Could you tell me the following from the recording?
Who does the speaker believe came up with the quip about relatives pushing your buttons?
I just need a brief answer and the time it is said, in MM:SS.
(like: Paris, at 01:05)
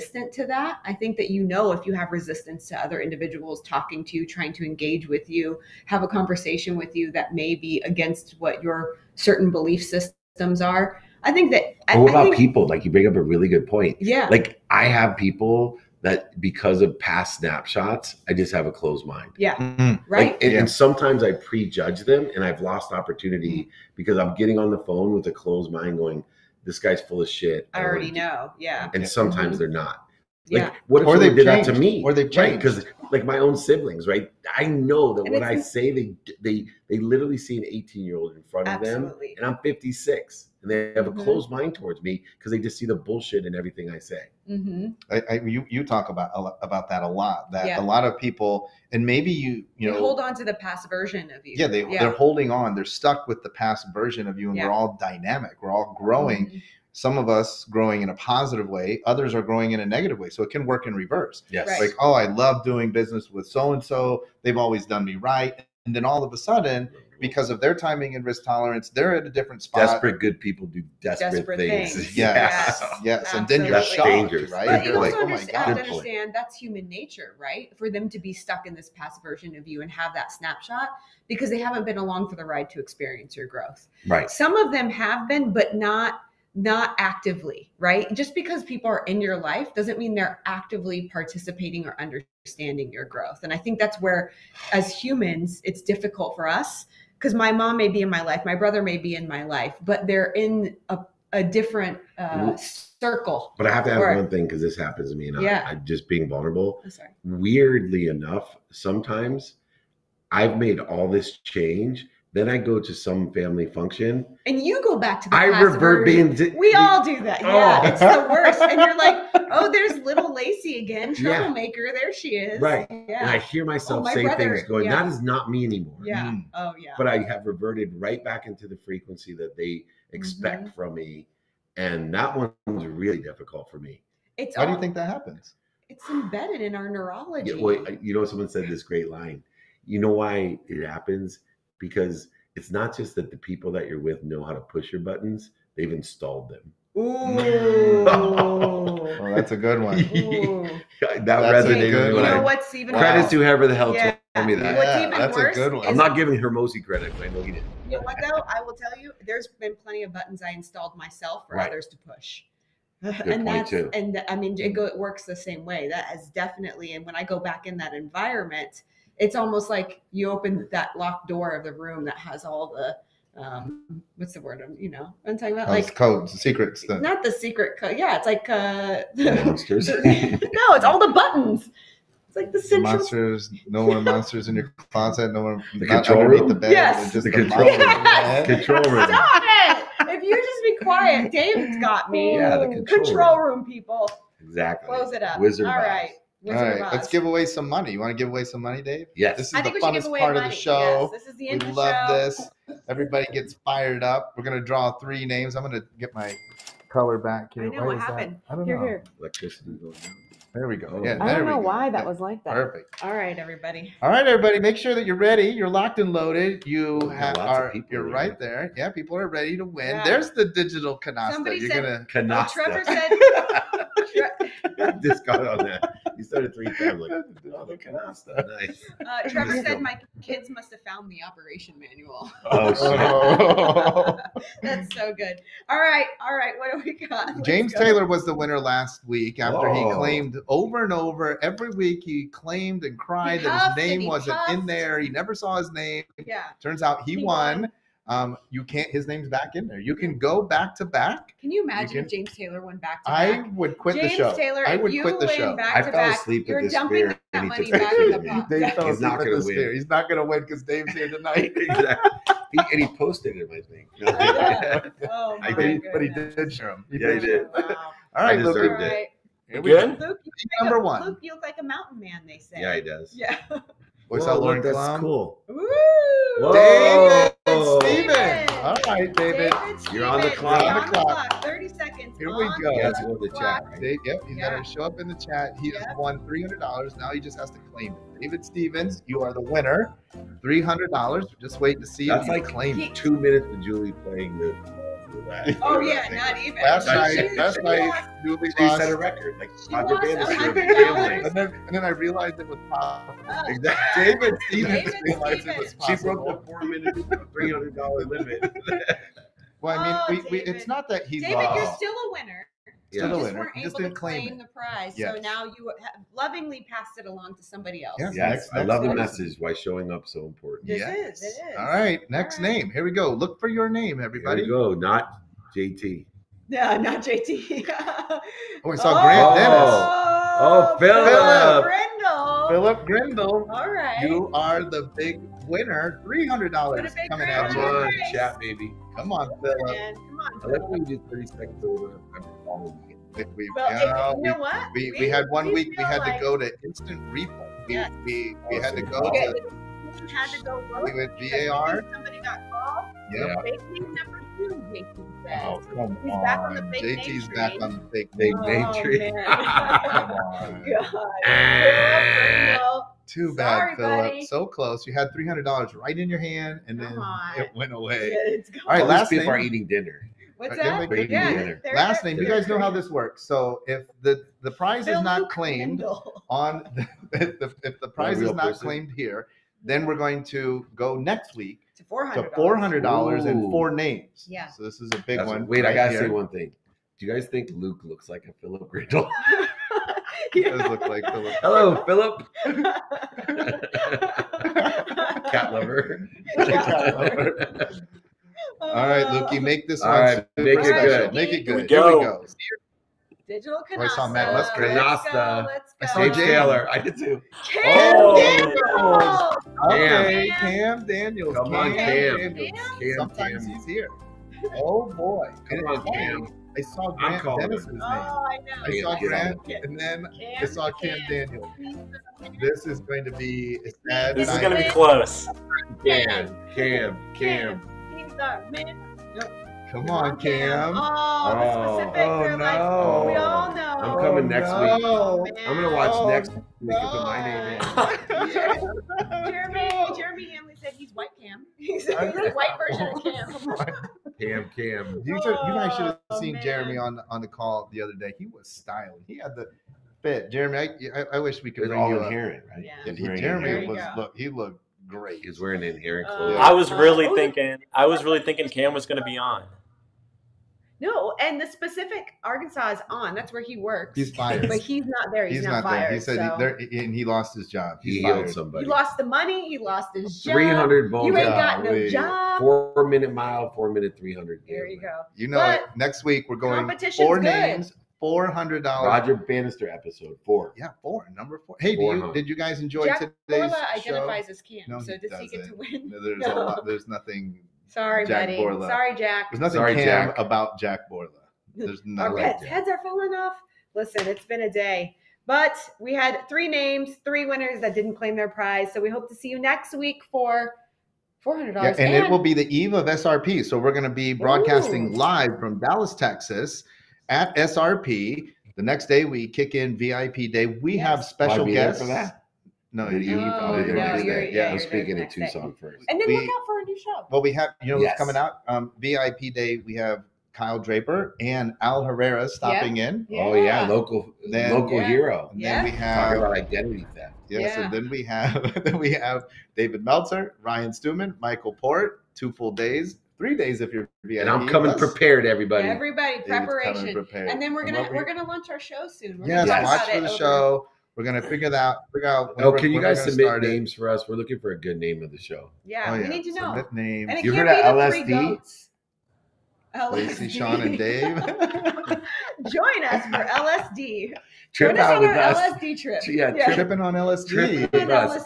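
Hormozi, at 02:36.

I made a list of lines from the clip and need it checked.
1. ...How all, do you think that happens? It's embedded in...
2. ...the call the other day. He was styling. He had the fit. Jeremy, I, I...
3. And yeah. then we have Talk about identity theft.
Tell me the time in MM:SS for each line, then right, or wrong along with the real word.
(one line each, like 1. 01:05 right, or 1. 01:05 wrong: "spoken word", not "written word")
1. 02:14 right
2. 07:27 right
3. 08:45 right.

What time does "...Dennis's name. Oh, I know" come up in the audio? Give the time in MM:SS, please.
06:57.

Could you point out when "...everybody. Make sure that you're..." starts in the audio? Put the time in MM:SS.
03:34.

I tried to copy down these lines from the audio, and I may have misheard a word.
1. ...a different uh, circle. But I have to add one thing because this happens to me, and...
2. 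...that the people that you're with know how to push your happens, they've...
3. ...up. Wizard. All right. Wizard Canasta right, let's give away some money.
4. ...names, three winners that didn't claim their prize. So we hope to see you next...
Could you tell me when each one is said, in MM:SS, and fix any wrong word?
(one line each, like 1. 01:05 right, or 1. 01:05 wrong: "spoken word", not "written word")
1. 01:41 right
2. 02:23 wrong: "buttons", not "happens"
3. 03:15 wrong: "All", not "Canasta"
4. 08:16 right.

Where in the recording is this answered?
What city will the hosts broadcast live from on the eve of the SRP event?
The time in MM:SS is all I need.
08:25.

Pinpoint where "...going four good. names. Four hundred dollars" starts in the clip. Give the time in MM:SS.
07:56.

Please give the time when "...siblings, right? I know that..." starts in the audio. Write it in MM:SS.
00:33.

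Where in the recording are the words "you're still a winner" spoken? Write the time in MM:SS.
05:11.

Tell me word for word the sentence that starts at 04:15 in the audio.
I fell asleep at this fair.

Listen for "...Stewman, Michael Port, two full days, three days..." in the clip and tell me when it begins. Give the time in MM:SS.
08:50.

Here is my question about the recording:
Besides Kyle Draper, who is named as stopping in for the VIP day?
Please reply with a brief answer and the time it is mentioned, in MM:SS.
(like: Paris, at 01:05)
Al Herrera, at 08:41.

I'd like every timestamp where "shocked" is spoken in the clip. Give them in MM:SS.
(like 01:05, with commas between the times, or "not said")
01:13.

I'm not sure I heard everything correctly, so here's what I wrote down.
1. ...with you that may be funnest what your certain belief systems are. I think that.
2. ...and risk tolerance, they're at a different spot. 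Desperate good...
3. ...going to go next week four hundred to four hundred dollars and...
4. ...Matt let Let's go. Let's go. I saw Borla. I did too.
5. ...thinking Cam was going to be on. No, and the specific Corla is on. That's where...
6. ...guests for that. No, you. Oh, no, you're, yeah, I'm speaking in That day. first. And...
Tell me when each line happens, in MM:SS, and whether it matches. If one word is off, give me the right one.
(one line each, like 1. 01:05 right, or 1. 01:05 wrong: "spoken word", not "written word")
1. 00:06 wrong: "against", not "funnest"
2. 01:08 right
3. 06:19 right
4. 06:44 wrong: "Taylor", not "Borla"
5. 07:38 wrong: "Arkansas", not "Corla"
6. 08:31 wrong: "Tucson", not "That".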